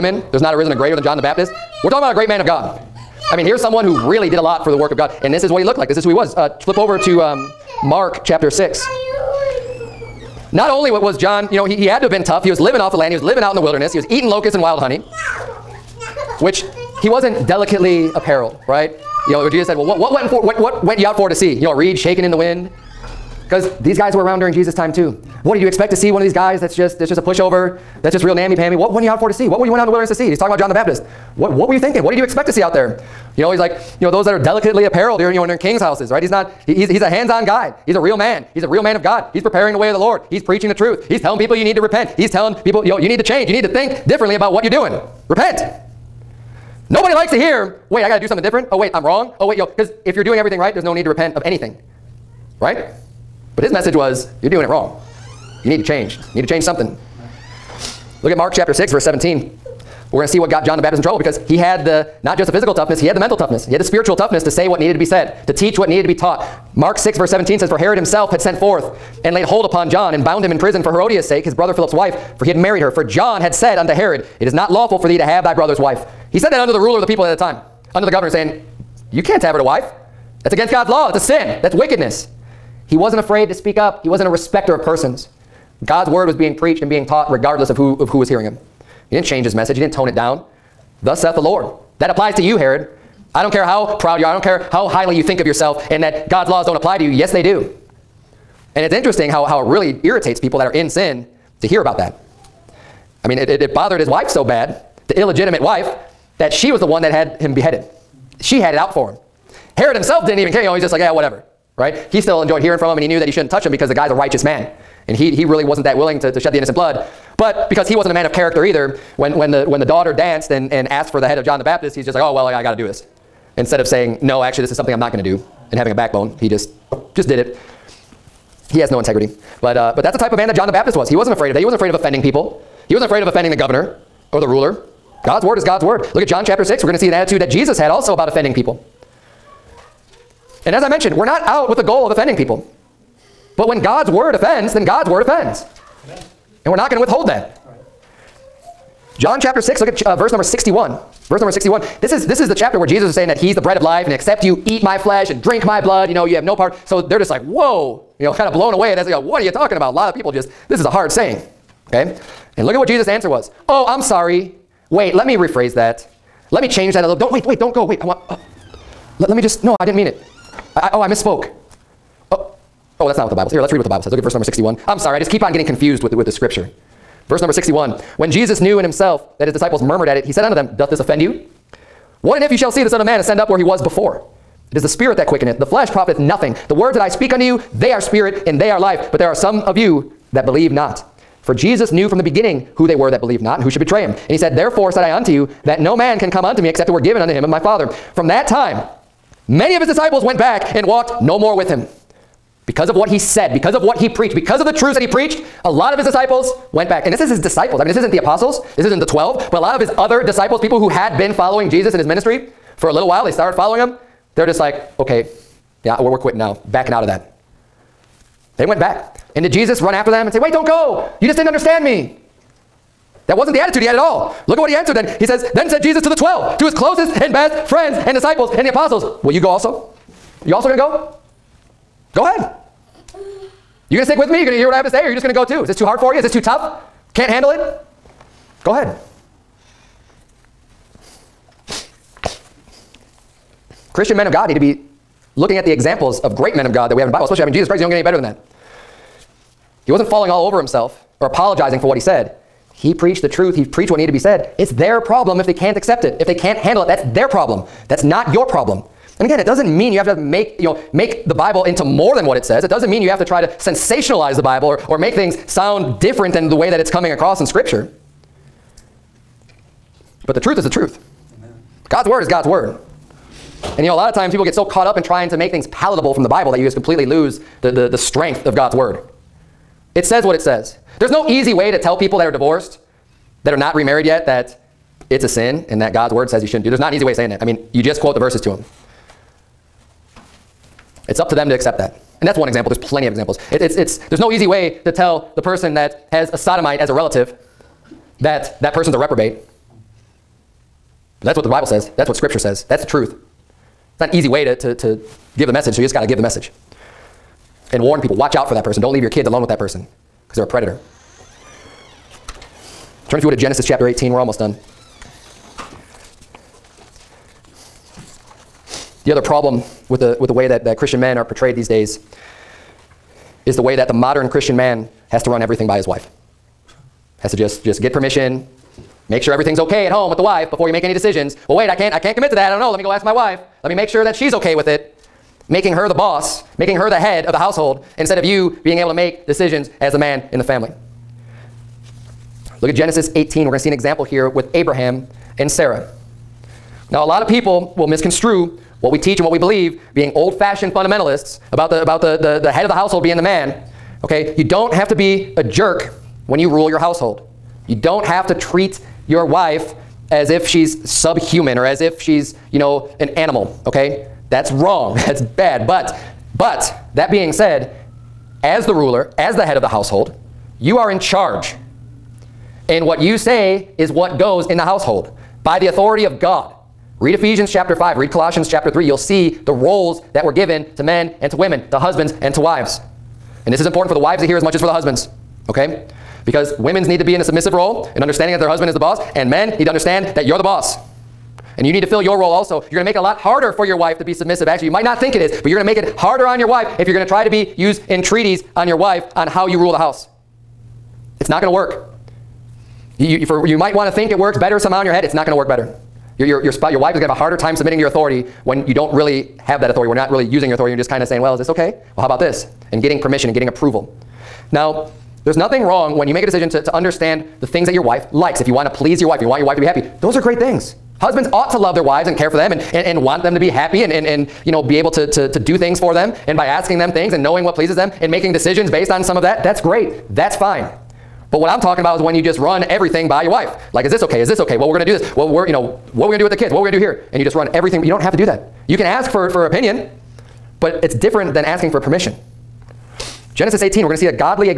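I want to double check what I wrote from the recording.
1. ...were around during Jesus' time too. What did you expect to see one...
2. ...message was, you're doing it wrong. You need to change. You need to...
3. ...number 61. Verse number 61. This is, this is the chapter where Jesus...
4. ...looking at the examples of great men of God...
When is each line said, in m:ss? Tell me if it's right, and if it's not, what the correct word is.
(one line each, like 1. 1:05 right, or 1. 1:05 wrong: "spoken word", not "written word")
1. 0:24 right
2. 0:53 right
3. 2:30 right
4. 4:05 right.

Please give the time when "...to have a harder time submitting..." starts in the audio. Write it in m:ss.
6:47.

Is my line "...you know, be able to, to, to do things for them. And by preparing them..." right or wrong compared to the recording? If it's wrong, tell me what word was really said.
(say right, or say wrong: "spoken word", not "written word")
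wrong: "asking", not "preparing".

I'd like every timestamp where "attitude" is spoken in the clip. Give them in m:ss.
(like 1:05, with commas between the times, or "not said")
2:17, 3:43.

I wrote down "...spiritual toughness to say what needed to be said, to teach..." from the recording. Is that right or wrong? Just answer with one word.
right.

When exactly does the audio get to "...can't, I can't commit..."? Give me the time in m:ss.
5:31.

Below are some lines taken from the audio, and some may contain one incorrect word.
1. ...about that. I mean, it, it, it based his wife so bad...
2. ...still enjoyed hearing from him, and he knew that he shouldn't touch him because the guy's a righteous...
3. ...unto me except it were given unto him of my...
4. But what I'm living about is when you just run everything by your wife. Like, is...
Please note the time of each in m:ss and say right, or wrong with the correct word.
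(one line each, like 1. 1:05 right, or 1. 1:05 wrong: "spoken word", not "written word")
1. 1:41 wrong: "bothered", not "based"
2. 1:52 right
3. 3:16 right
4. 7:11 wrong: "talking", not "living".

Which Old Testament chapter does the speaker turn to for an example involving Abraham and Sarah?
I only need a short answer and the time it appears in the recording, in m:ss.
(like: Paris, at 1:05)
Genesis 18, at 5:13.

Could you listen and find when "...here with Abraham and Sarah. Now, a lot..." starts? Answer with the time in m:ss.
5:44.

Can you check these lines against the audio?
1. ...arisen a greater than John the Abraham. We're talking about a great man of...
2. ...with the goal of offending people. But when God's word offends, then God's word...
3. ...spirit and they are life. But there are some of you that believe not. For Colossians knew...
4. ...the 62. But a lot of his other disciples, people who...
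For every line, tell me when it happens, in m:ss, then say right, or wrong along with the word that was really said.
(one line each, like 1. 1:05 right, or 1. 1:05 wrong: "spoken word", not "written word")
1. 0:00 wrong: "Baptist", not "Abraham"
2. 2:21 right
3. 3:08 wrong: "Jesus", not "Colossians"
4. 3:28 wrong: "12", not "62".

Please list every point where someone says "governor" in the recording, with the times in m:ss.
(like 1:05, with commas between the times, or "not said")
1:18, 2:13.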